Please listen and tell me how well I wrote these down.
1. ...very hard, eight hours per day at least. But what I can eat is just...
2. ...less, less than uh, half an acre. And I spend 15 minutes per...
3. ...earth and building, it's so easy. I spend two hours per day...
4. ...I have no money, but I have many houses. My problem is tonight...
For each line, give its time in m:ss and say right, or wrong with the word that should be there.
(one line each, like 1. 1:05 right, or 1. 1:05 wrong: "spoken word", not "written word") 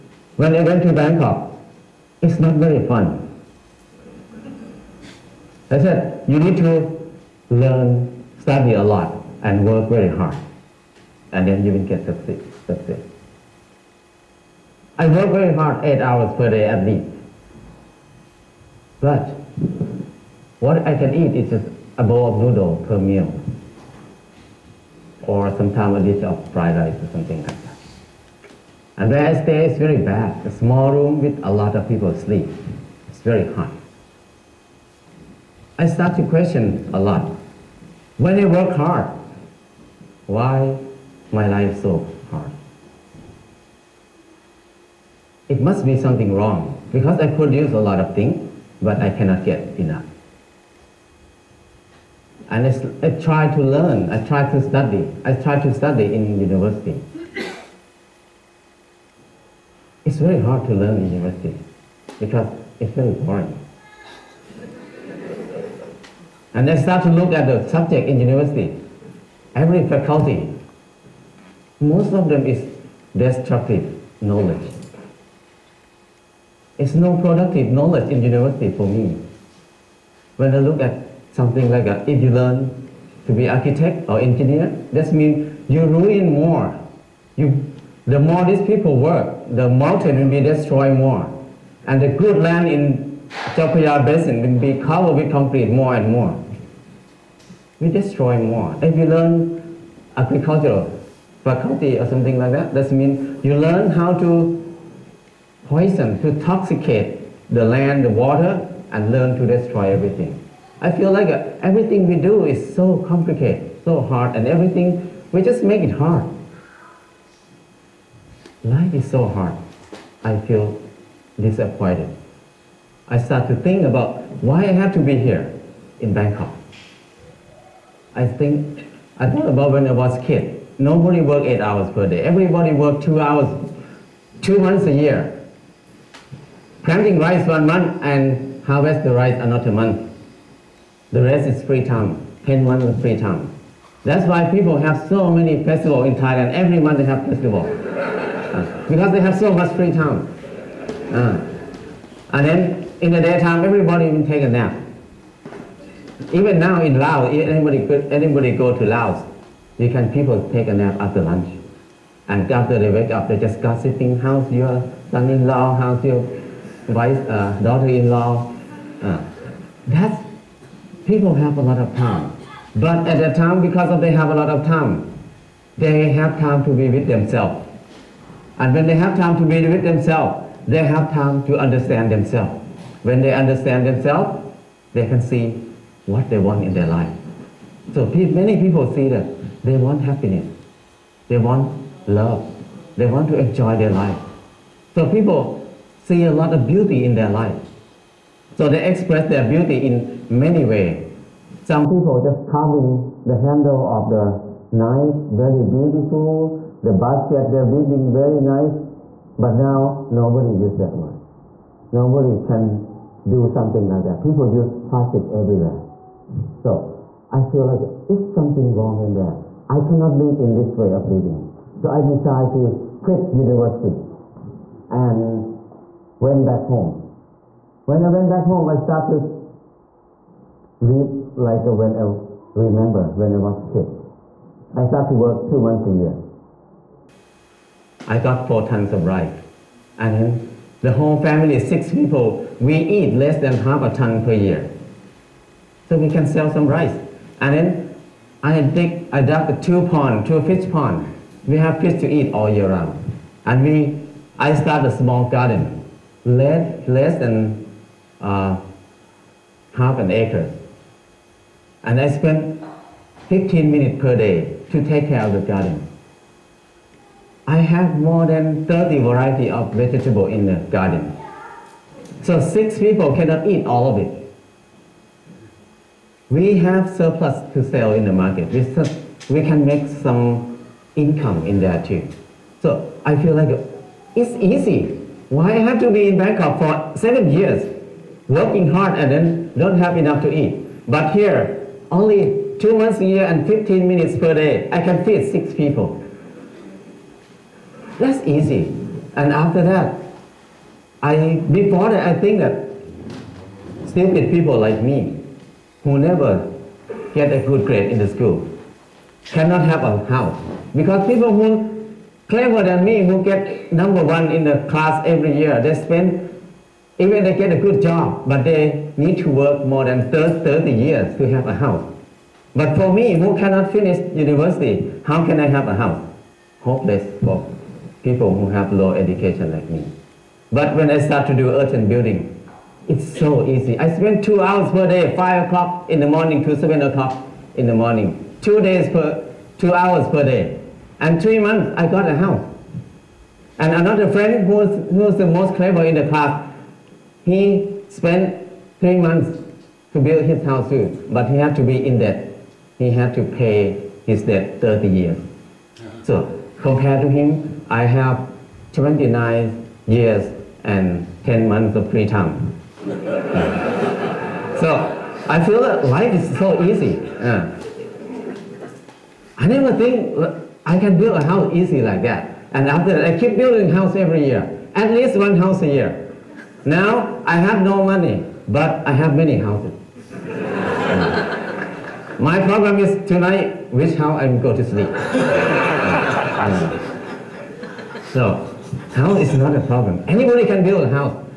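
1. 0:15 right
2. 4:16 right
3. 5:31 right
4. 6:17 right.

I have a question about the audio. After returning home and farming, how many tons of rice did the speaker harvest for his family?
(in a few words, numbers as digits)
4.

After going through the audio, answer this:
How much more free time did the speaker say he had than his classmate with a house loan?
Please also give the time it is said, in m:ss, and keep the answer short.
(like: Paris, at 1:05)
29 years and 10 months, at 5:58.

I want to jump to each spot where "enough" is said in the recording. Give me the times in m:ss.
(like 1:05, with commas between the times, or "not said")
0:49, 4:49.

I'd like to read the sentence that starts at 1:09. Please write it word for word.
Every faculty, most of them is destructive knowledge.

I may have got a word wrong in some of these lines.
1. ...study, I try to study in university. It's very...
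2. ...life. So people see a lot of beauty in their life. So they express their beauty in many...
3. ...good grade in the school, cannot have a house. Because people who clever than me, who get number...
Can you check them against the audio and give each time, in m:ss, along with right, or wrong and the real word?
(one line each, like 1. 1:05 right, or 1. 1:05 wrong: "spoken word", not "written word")
1. 0:54 right
2. 3:13 right
3. 5:07 right.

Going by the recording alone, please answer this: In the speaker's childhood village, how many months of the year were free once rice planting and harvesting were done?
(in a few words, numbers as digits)
10.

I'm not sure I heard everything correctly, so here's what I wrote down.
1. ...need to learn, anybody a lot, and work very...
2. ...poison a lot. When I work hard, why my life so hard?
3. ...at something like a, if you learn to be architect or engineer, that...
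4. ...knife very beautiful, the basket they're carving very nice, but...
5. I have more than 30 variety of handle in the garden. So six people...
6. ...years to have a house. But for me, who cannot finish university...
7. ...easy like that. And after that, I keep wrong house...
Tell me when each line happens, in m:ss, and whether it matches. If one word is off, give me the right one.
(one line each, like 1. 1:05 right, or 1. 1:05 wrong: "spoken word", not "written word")
1. 0:06 wrong: "study", not "anybody"
2. 0:36 wrong: "question", not "poison"
3. 1:20 right
4. 3:24 wrong: "weaving", not "carving"
5. 4:27 wrong: "vegetable", not "handle"
6. 5:20 right
7. 6:11 wrong: "building", not "wrong".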